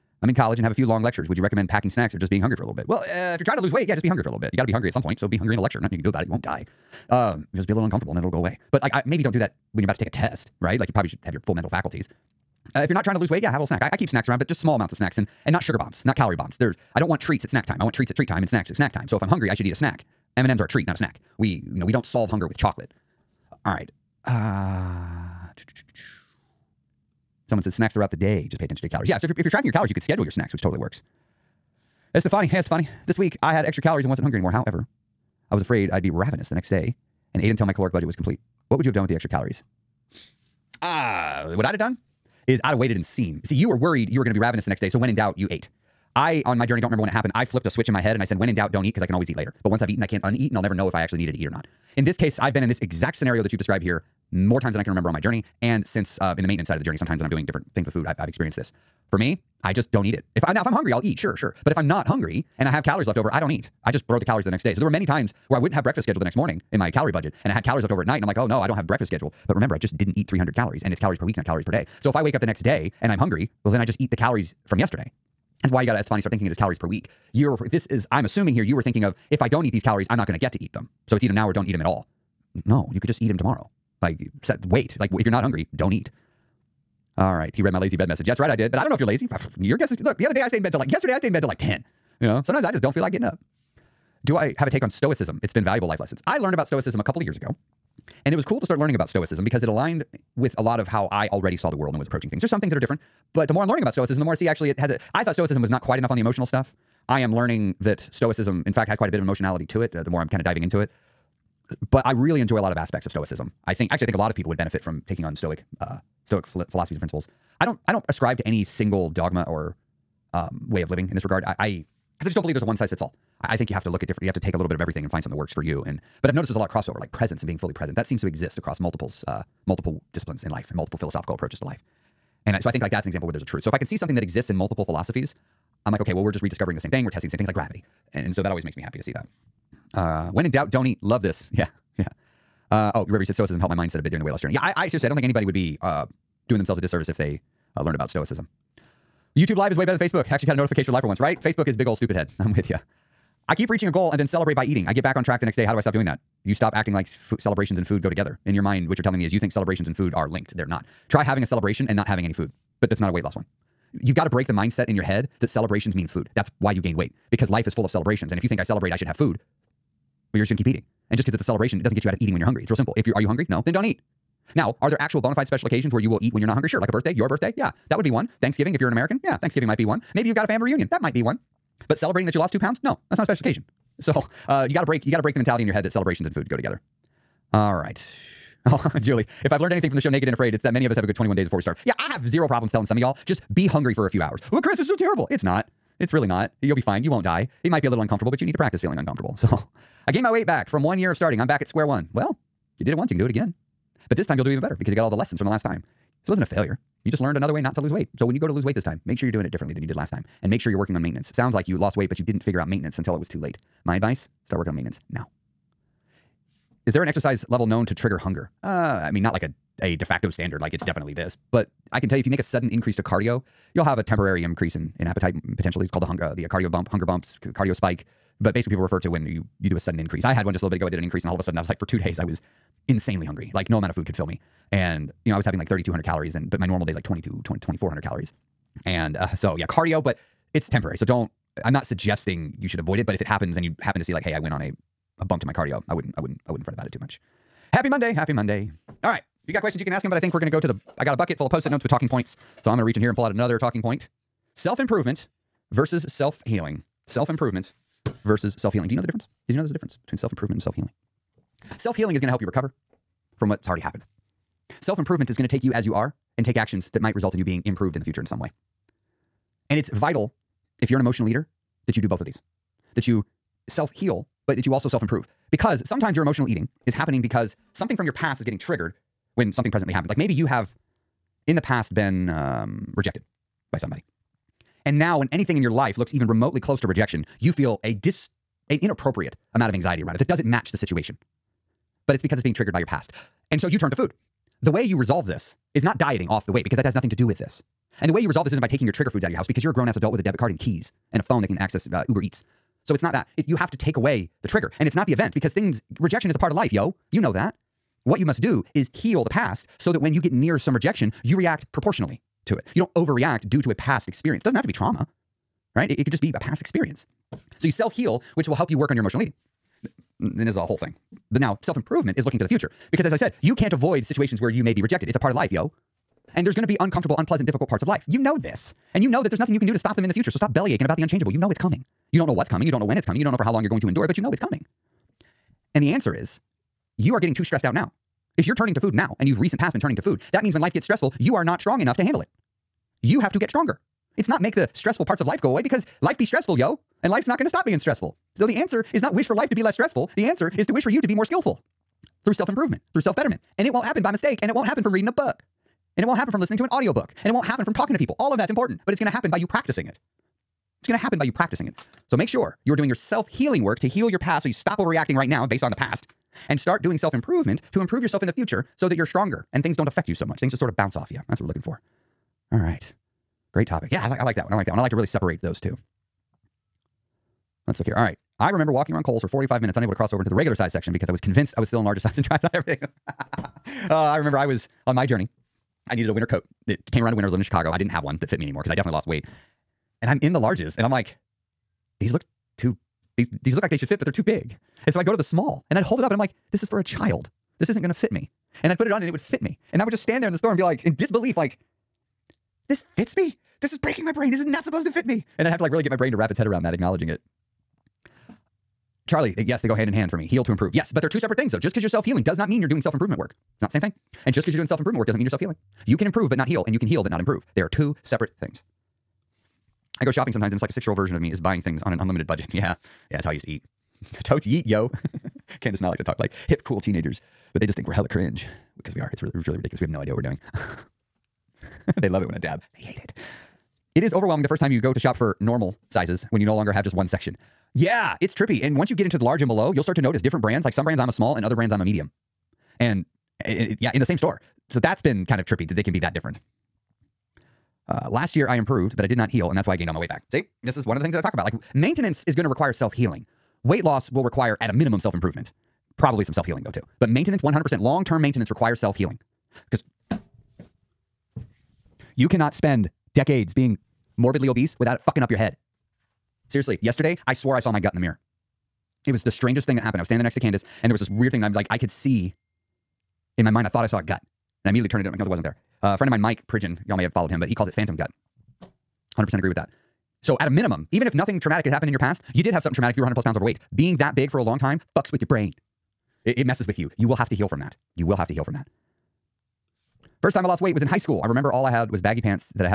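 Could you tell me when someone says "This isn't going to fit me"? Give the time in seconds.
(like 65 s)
397 s.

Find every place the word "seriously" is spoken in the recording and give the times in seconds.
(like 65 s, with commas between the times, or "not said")
144 s, 466 s.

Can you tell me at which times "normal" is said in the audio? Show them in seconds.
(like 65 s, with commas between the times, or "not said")
236 s, 435 s.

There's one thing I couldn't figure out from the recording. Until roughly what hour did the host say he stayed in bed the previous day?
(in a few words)
10.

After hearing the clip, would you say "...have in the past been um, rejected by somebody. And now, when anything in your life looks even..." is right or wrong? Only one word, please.
right.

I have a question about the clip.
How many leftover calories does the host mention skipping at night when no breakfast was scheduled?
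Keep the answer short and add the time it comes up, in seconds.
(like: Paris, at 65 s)
300, at 70 s.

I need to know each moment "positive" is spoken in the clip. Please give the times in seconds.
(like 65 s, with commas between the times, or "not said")
not said.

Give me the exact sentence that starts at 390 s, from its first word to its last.
And I'm in the larges and I'm like, these look too these these look like they should fit, but they're too big.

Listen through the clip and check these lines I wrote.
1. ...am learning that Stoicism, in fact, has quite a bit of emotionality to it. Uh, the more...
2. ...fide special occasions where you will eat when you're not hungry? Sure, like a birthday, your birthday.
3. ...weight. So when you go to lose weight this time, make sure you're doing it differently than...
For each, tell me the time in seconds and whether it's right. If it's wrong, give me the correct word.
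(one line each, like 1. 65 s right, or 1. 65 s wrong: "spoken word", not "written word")
1. 107 s right
2. 175 s right
3. 207 s right.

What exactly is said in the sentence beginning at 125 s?
And but I've noticed there's a lot of crossover, like presence and being fully present.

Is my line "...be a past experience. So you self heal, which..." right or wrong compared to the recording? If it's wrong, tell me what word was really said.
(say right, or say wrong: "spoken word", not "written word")
right.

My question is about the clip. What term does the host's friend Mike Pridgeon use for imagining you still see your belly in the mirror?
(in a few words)
phantom gut.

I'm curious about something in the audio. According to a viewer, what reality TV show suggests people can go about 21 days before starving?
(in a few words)
Naked and Afraid.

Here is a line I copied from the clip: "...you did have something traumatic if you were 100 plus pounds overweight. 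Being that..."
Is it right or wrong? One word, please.
right.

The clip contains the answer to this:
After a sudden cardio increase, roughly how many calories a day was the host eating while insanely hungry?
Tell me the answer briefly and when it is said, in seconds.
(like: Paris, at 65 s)
3,200, at 235 s.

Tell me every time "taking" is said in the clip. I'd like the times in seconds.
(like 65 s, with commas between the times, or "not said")
115 s, 298 s.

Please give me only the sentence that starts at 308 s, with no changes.
What you must do is heal the past so that when you get near some rejection, you react proportionally to it.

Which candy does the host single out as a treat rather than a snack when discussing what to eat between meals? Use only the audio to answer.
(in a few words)
M&Ms.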